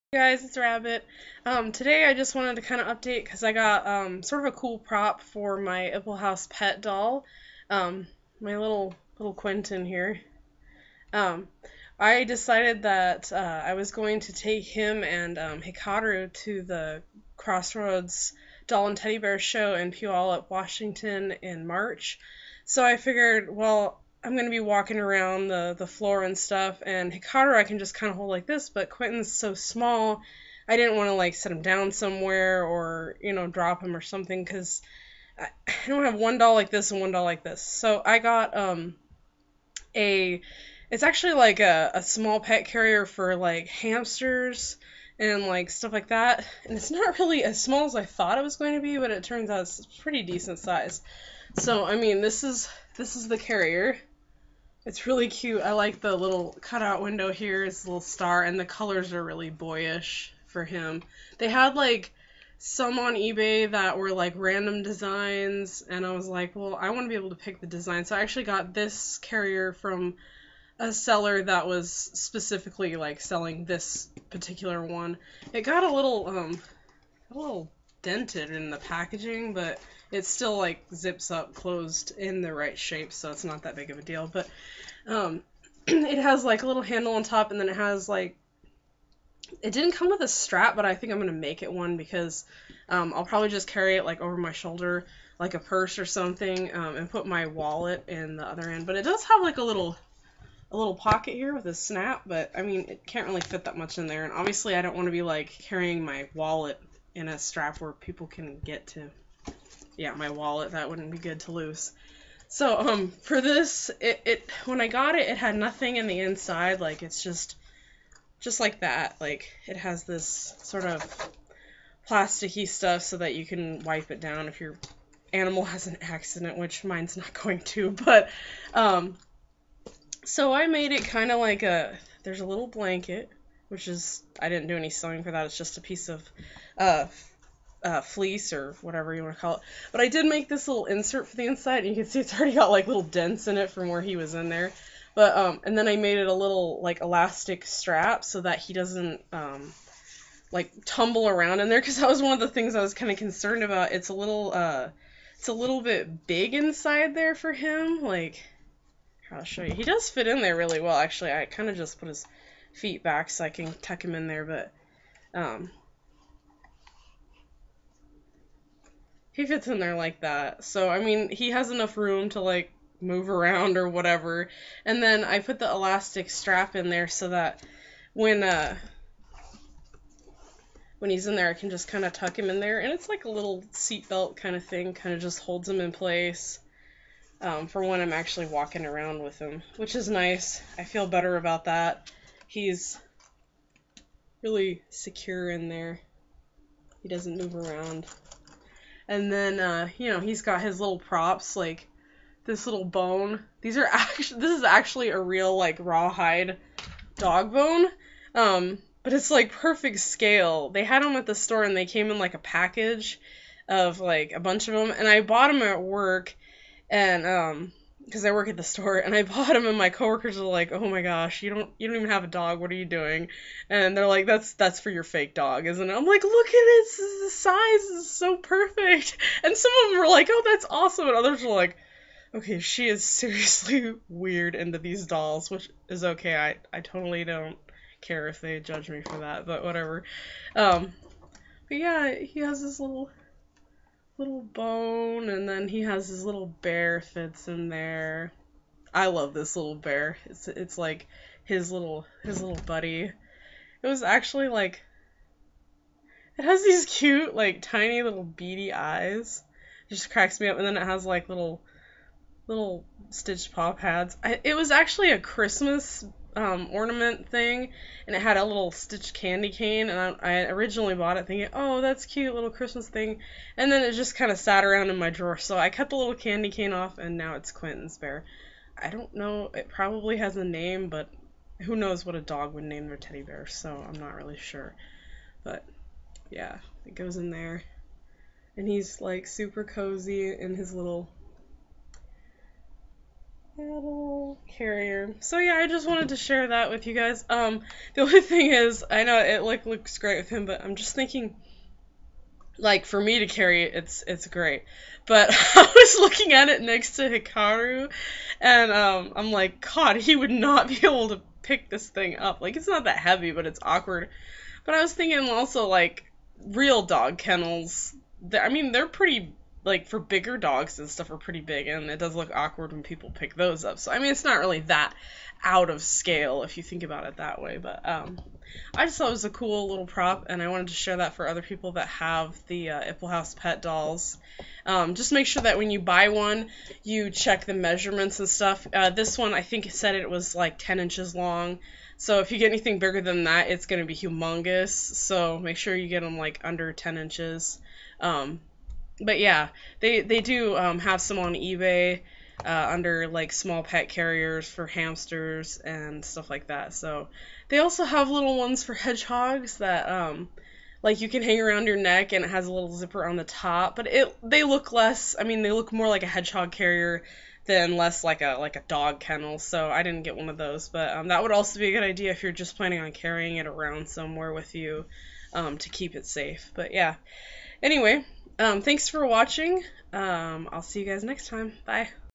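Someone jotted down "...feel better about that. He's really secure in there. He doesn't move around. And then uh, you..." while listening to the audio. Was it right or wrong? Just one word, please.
right.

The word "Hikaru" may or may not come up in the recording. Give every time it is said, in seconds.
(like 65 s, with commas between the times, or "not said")
15 s, 27 s, 307 s.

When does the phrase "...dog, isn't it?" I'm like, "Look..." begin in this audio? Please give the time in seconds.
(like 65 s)
225 s.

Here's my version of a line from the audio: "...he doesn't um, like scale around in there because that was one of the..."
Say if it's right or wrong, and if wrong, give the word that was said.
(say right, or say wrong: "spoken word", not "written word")
wrong: "tumble", not "scale".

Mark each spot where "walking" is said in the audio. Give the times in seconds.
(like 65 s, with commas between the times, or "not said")
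24 s, 188 s.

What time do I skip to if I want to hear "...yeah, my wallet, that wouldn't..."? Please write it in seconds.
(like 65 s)
110 s.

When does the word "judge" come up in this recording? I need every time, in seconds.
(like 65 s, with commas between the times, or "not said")
238 s.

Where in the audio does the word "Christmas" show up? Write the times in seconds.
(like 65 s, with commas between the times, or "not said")
265 s, 272 s.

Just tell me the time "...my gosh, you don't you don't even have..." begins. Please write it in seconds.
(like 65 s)
220 s.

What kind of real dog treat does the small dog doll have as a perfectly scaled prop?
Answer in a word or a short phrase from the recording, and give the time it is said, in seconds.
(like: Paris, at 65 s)
Rawhide dog bone, at 205 s.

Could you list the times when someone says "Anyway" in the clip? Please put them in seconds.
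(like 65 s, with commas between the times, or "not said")
377 s.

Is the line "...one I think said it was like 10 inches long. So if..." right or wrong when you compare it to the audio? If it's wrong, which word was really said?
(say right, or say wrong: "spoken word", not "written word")
right.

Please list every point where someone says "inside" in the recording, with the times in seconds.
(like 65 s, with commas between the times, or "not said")
116 s, 141 s, 156 s.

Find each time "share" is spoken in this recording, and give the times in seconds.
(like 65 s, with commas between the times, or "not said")
296 s, 330 s.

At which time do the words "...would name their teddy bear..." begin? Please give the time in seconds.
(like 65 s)
282 s.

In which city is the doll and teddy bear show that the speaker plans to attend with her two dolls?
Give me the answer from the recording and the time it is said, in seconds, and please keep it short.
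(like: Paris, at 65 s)
Puyallup, Washington, at 19 s.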